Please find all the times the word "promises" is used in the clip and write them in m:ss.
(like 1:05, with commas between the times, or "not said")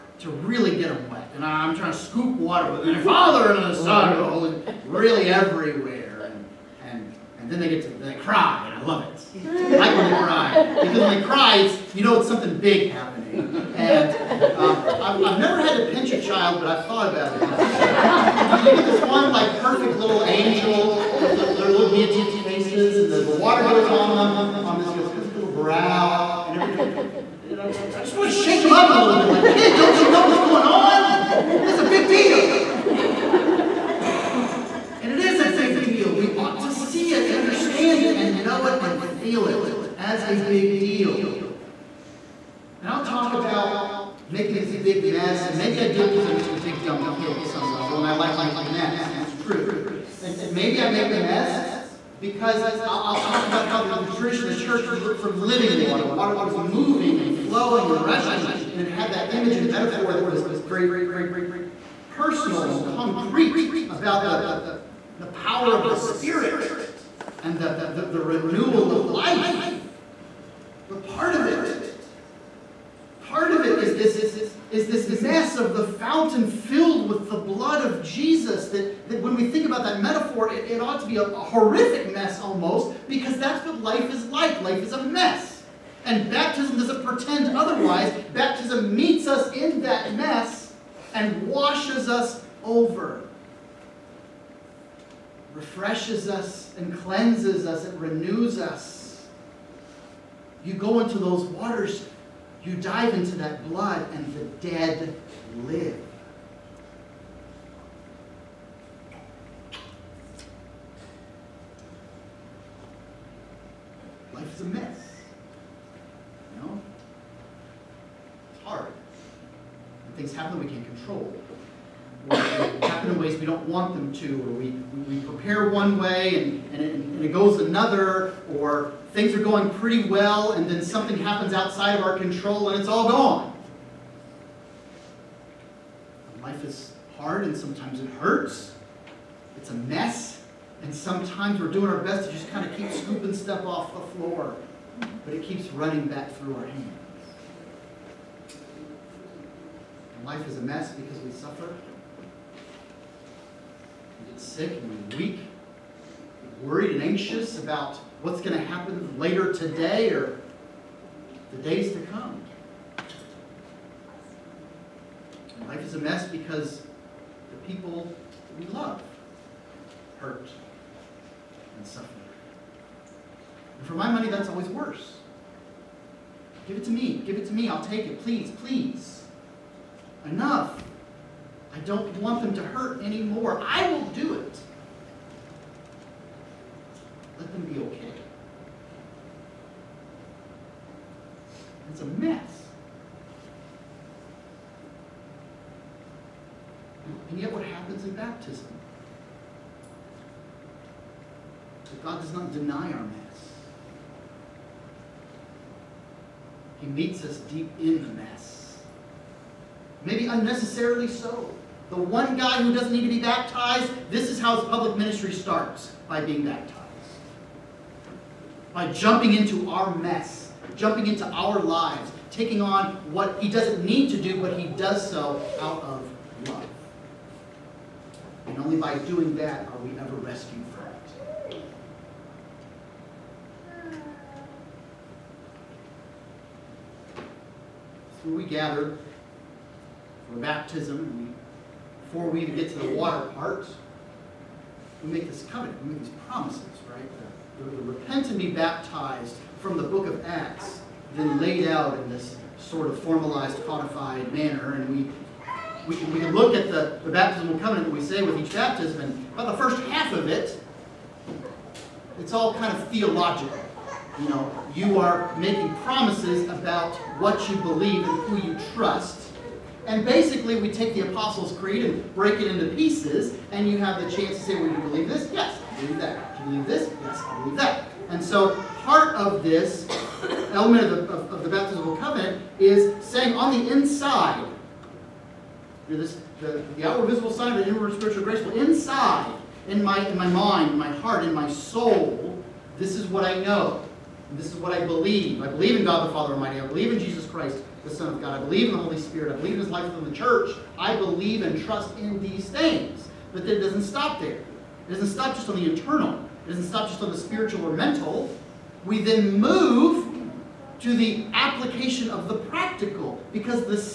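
4:06, 4:25.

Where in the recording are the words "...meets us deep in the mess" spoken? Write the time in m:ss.
3:26.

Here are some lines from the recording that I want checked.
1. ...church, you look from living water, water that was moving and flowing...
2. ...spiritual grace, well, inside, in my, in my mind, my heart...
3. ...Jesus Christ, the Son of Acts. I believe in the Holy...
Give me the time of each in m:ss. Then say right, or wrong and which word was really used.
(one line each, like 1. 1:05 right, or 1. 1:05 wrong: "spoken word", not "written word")
1. 0:54 right
2. 4:47 right
3. 4:56 wrong: "God", not "Acts".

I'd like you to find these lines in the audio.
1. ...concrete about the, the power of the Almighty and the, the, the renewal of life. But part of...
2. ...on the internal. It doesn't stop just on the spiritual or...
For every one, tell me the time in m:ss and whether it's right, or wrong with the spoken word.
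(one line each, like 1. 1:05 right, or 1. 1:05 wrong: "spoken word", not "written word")
1. 1:02 wrong: "Spirit", not "Almighty"
2. 5:05 right.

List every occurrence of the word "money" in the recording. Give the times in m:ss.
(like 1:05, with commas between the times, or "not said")
2:54.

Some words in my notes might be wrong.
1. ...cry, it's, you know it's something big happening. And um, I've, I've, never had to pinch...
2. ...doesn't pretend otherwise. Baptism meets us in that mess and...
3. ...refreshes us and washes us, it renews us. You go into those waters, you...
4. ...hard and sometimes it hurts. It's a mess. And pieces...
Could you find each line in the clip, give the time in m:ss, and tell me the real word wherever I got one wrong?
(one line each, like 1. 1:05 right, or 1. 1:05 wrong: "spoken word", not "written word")
1. 0:11 right
2. 1:26 right
3. 1:35 wrong: "cleanses", not "washes"
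4. 2:17 wrong: "sometimes", not "pieces".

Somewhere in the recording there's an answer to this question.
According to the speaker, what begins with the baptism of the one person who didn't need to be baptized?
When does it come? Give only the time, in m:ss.
3:34.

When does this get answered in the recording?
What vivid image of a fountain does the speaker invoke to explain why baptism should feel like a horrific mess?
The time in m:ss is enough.
1:15.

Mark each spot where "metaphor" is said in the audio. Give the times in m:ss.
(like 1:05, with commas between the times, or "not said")
0:59, 1:20.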